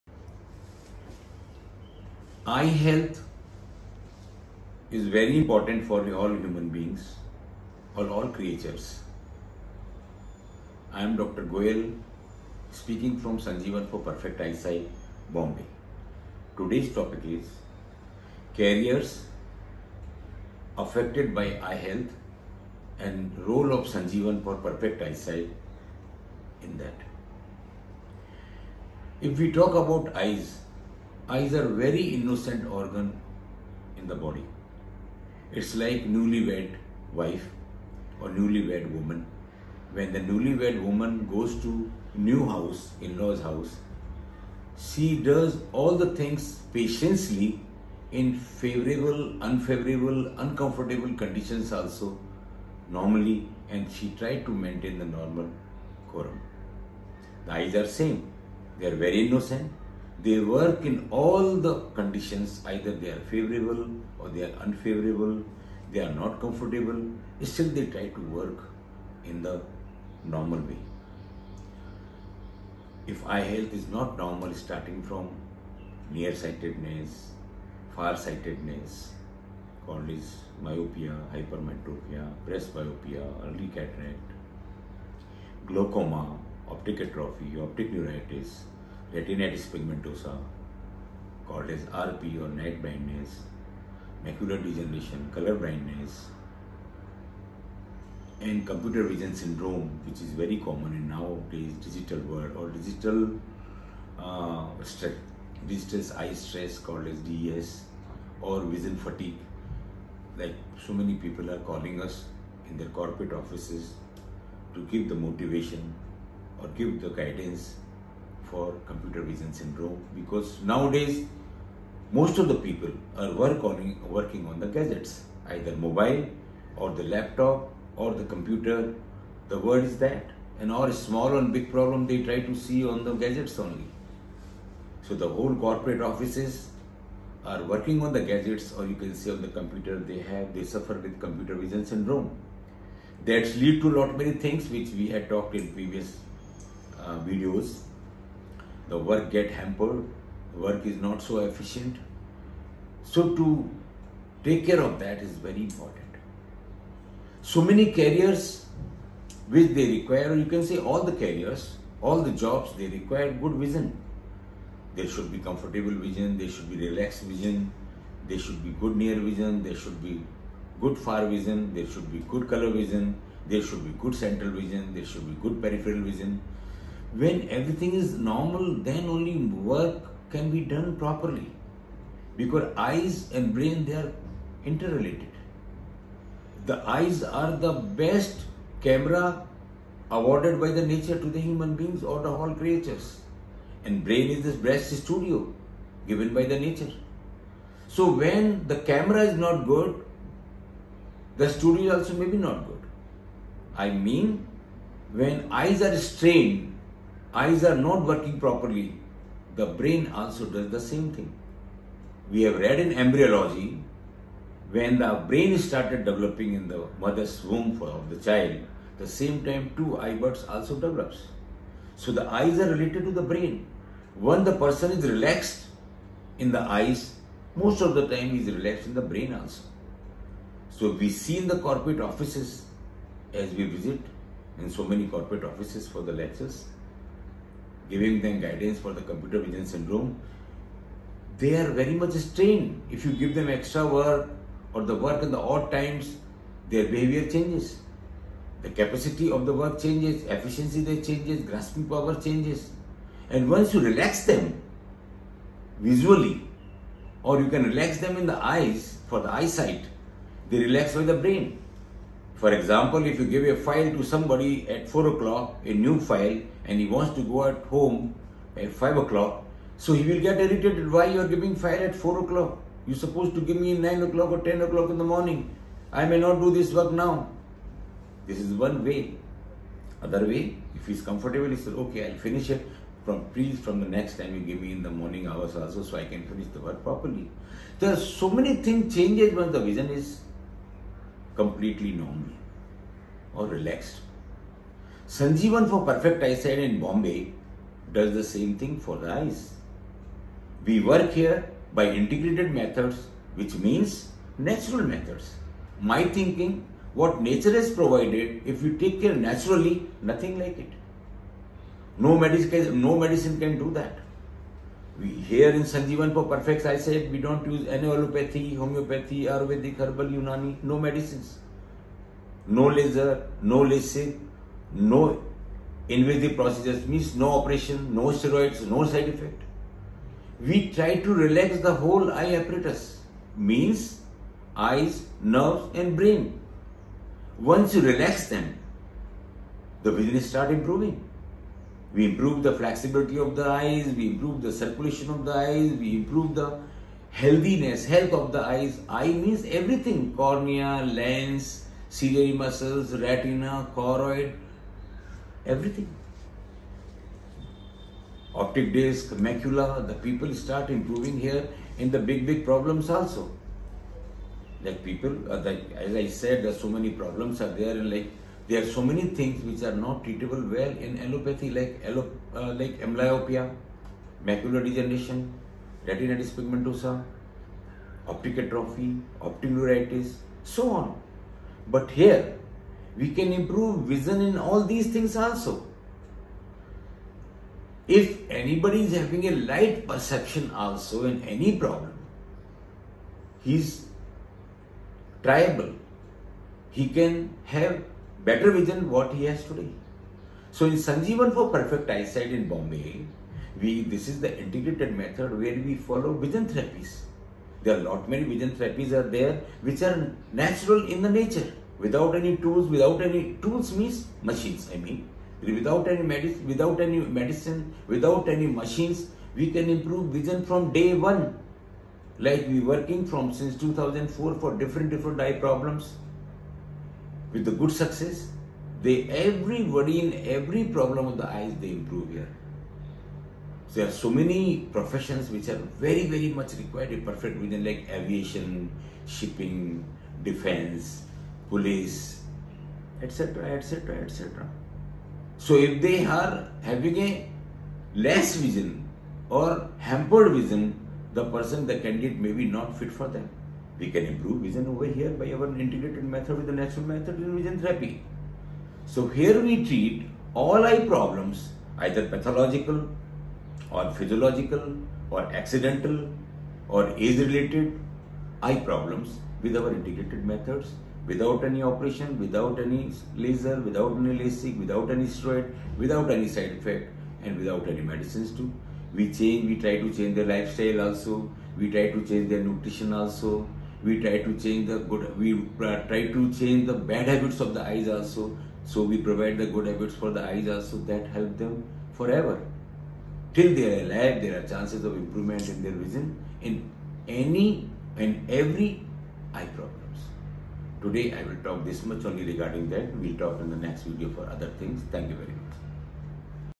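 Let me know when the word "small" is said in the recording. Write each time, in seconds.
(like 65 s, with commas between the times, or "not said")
130 s.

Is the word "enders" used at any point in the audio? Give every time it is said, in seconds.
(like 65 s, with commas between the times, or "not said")
not said.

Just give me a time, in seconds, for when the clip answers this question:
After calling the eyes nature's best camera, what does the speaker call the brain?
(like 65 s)
194 s.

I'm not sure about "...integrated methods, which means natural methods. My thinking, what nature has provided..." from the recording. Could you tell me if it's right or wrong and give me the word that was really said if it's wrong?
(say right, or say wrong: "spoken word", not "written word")
right.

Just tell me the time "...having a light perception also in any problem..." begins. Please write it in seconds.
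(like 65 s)
388 s.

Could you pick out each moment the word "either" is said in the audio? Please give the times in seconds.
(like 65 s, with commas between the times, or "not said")
62 s, 125 s, 461 s.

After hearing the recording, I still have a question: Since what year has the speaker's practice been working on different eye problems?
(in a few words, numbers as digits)
2004.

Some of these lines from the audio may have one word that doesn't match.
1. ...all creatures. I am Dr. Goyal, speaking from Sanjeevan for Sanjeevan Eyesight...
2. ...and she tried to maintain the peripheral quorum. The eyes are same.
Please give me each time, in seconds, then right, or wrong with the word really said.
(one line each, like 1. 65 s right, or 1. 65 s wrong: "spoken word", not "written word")
1. 8 s wrong: "Perfect", not "Sanjeevan"
2. 53 s wrong: "normal", not "peripheral".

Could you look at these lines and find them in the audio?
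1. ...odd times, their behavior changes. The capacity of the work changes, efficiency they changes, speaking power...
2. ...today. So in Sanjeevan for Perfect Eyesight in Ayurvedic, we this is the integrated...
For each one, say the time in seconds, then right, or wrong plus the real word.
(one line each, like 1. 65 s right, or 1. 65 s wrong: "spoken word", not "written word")
1. 245 s wrong: "grasping", not "speaking"
2. 399 s wrong: "Bombay", not "Ayurvedic".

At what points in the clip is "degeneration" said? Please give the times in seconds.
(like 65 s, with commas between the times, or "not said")
94 s, 374 s.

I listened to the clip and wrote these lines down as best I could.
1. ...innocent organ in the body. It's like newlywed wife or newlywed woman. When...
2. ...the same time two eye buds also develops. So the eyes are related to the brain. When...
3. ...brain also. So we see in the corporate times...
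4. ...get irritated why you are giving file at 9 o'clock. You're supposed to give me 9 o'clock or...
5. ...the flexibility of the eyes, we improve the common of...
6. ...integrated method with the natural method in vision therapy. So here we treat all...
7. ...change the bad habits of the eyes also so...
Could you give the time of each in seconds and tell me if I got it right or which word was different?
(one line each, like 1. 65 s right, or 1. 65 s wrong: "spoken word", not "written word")
1. 32 s right
2. 218 s right
3. 229 s wrong: "offices", not "times"
4. 270 s wrong: "4", not "9"
5. 342 s wrong: "circulation", not "common"
6. 455 s right
7. 486 s right.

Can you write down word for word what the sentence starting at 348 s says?
Eye means everything, cornea, lens, ciliary muscles, retina, choroid, everything.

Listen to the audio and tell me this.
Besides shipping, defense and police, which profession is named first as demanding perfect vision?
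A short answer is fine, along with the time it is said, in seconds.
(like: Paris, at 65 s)
aviation, at 437 s.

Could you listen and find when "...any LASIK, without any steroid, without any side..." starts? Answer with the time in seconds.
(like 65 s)
473 s.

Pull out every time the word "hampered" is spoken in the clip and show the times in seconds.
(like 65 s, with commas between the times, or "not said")
149 s, 449 s.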